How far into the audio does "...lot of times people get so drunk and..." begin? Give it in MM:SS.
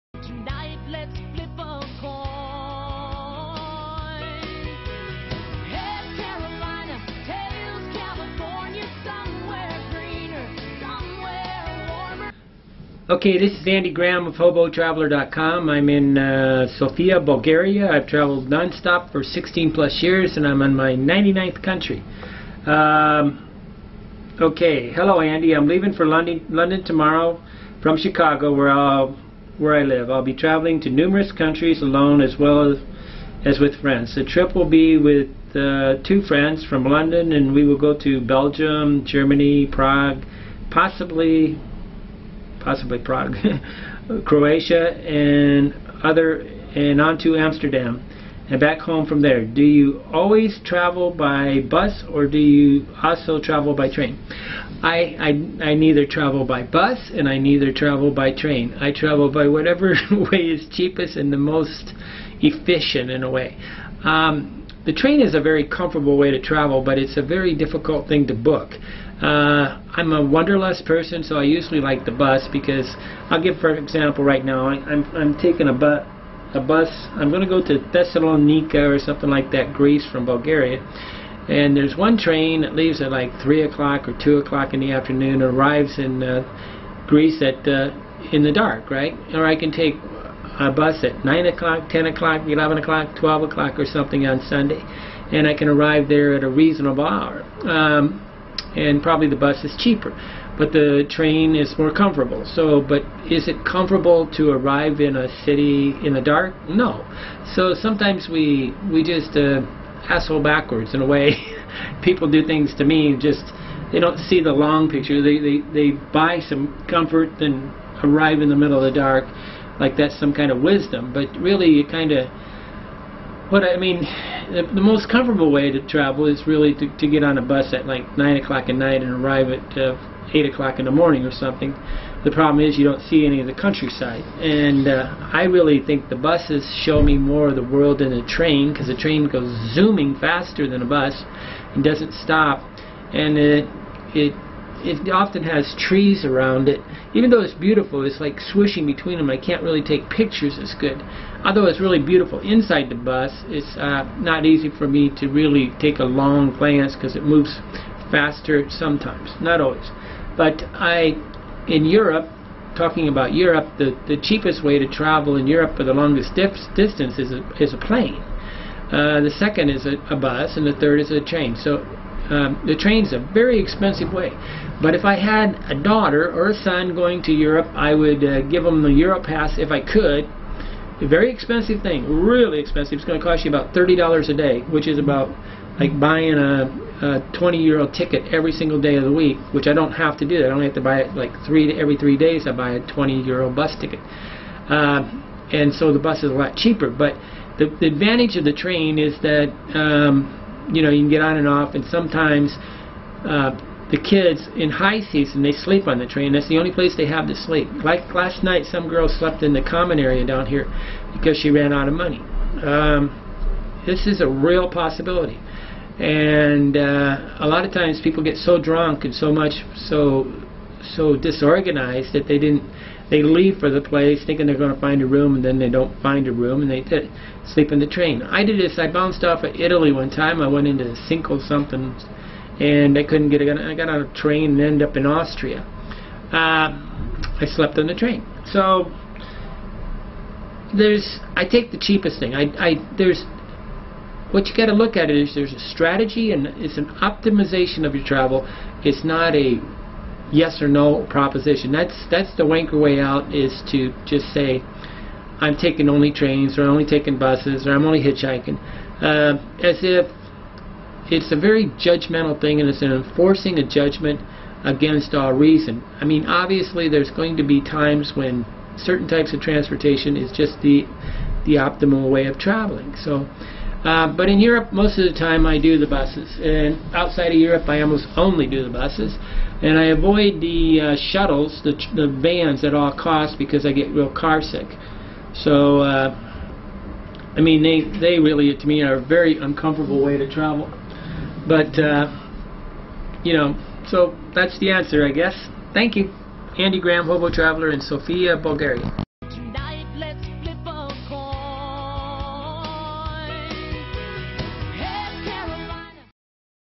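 03:37.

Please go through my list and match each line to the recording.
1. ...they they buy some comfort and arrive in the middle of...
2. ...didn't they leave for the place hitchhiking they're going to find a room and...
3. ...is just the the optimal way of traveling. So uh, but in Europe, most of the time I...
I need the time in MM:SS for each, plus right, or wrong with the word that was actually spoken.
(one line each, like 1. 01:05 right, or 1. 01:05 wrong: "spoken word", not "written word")
1. 01:55 right
2. 03:42 wrong: "thinking", not "hitchhiking"
3. 04:30 right.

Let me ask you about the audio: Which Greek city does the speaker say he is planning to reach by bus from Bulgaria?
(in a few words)
Thessalonica.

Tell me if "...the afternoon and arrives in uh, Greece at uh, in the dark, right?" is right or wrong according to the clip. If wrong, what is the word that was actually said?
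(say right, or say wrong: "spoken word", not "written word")
right.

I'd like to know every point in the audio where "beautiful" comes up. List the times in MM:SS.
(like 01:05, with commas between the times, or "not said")
02:27, 02:31.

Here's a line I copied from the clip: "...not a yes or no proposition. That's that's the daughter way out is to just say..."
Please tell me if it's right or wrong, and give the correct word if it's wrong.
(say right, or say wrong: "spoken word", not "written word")
wrong: "wanker", not "daughter".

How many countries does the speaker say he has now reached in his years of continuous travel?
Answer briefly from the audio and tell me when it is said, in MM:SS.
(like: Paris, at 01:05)
99, at 00:20.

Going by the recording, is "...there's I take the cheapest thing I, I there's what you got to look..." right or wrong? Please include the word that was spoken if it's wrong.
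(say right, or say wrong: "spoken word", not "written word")
right.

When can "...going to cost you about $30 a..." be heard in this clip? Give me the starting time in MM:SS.
03:03.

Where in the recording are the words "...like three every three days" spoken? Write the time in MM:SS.
03:11.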